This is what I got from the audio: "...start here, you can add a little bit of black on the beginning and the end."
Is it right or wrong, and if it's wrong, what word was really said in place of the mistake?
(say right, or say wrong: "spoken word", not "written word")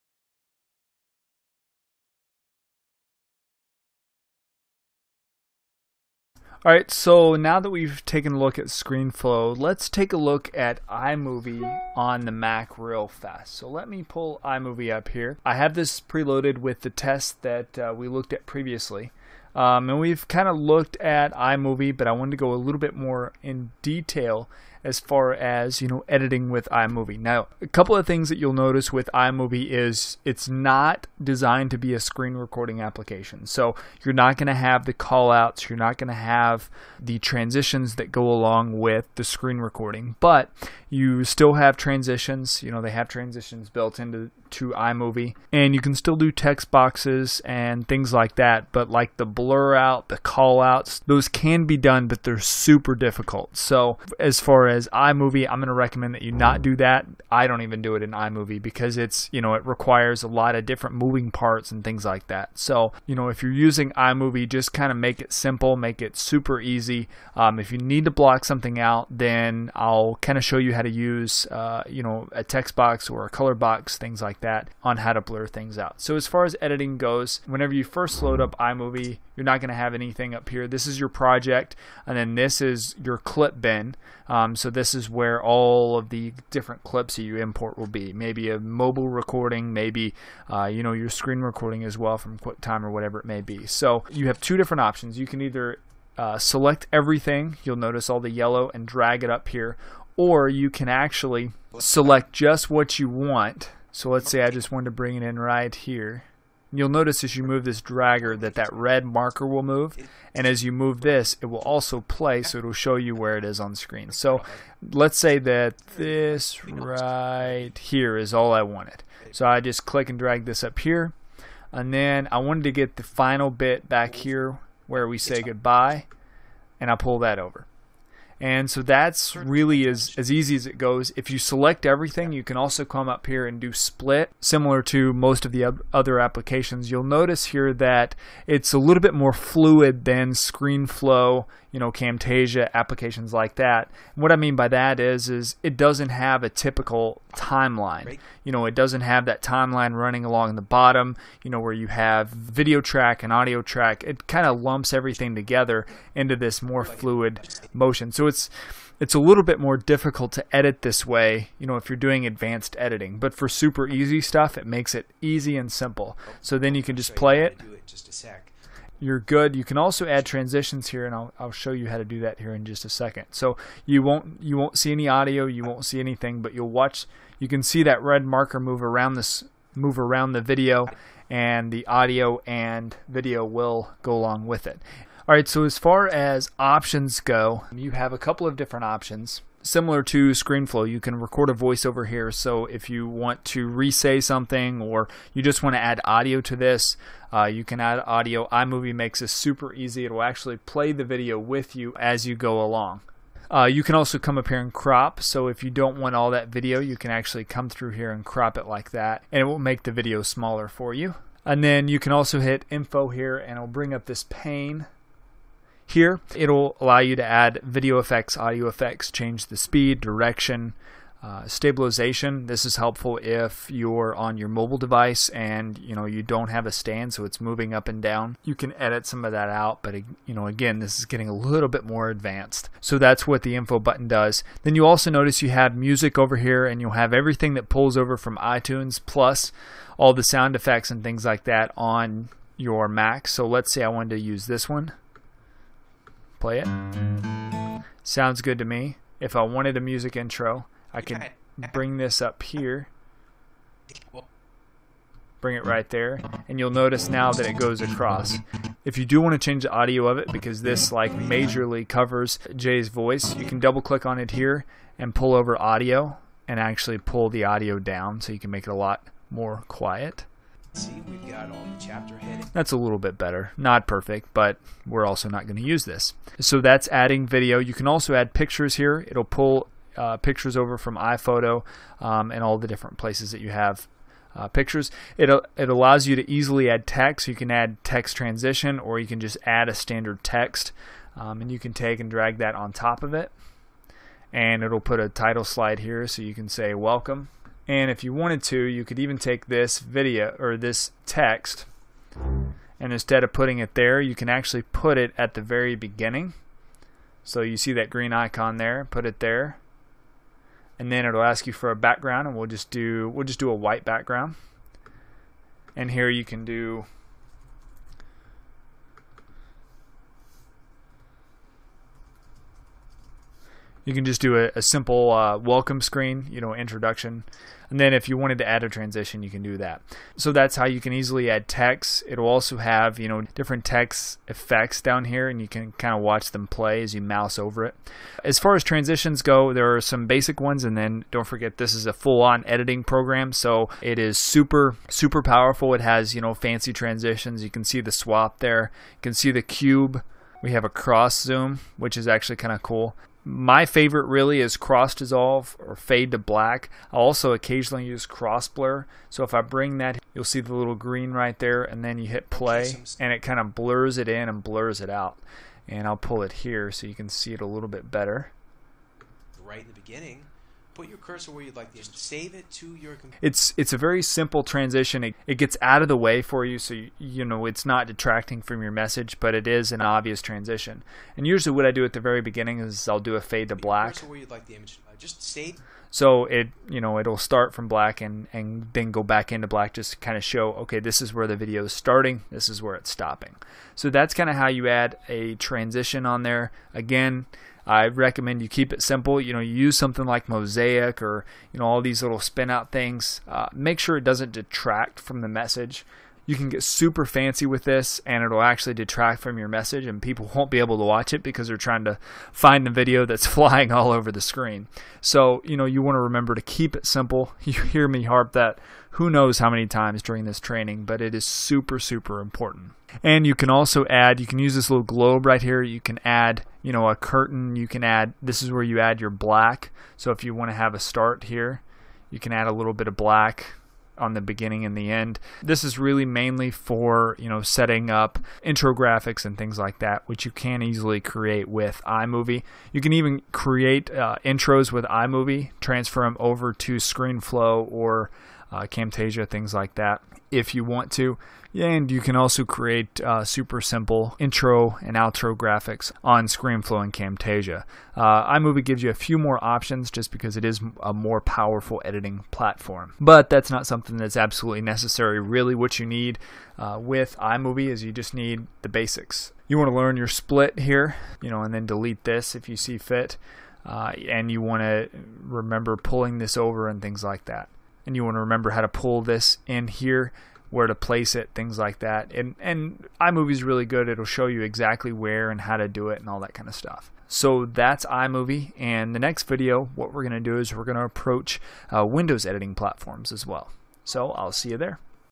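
right.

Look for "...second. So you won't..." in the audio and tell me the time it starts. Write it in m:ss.
2:52.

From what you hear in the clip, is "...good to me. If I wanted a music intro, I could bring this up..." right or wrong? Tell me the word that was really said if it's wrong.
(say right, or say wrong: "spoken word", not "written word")
right.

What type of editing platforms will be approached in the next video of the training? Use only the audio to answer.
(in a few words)
Windows.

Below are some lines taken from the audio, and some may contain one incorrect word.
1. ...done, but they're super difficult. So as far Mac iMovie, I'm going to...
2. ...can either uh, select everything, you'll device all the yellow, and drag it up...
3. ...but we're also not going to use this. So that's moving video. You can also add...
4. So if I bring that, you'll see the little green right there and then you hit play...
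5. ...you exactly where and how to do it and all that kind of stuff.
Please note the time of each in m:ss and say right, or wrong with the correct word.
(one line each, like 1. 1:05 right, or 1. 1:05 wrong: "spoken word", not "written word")
1. 0:51 wrong: "Whereas", not "Mac"
2. 1:35 wrong: "notice", not "device"
3. 4:34 wrong: "adding", not "moving"
4. 5:59 right
5. 8:04 right.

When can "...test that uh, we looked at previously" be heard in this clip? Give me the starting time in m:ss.
0:16.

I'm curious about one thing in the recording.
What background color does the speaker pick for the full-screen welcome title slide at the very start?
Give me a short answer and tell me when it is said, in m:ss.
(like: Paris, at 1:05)
White, at 5:13.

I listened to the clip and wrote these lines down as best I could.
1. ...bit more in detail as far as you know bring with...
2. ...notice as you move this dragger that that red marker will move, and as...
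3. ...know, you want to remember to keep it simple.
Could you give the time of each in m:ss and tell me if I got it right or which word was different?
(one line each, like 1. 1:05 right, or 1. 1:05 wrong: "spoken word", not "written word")
1. 0:22 wrong: "editing", not "bring"
2. 1:46 right
3. 6:55 right.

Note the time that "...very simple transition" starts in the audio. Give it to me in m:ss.
6:13.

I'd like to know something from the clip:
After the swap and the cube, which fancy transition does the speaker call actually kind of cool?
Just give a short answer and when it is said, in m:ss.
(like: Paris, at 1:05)
Cross zoom, at 5:50.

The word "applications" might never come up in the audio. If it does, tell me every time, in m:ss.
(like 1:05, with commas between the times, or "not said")
0:32, 2:16, 2:22.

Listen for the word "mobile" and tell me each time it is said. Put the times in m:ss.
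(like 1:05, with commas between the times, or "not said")
1:28, 3:44.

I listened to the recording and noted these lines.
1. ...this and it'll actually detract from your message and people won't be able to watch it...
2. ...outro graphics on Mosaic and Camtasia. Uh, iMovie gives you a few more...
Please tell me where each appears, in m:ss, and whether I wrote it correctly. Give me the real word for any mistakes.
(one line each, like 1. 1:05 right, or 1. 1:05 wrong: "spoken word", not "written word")
1. 6:47 right
2. 7:34 wrong: "ScreenFlow", not "Mosaic".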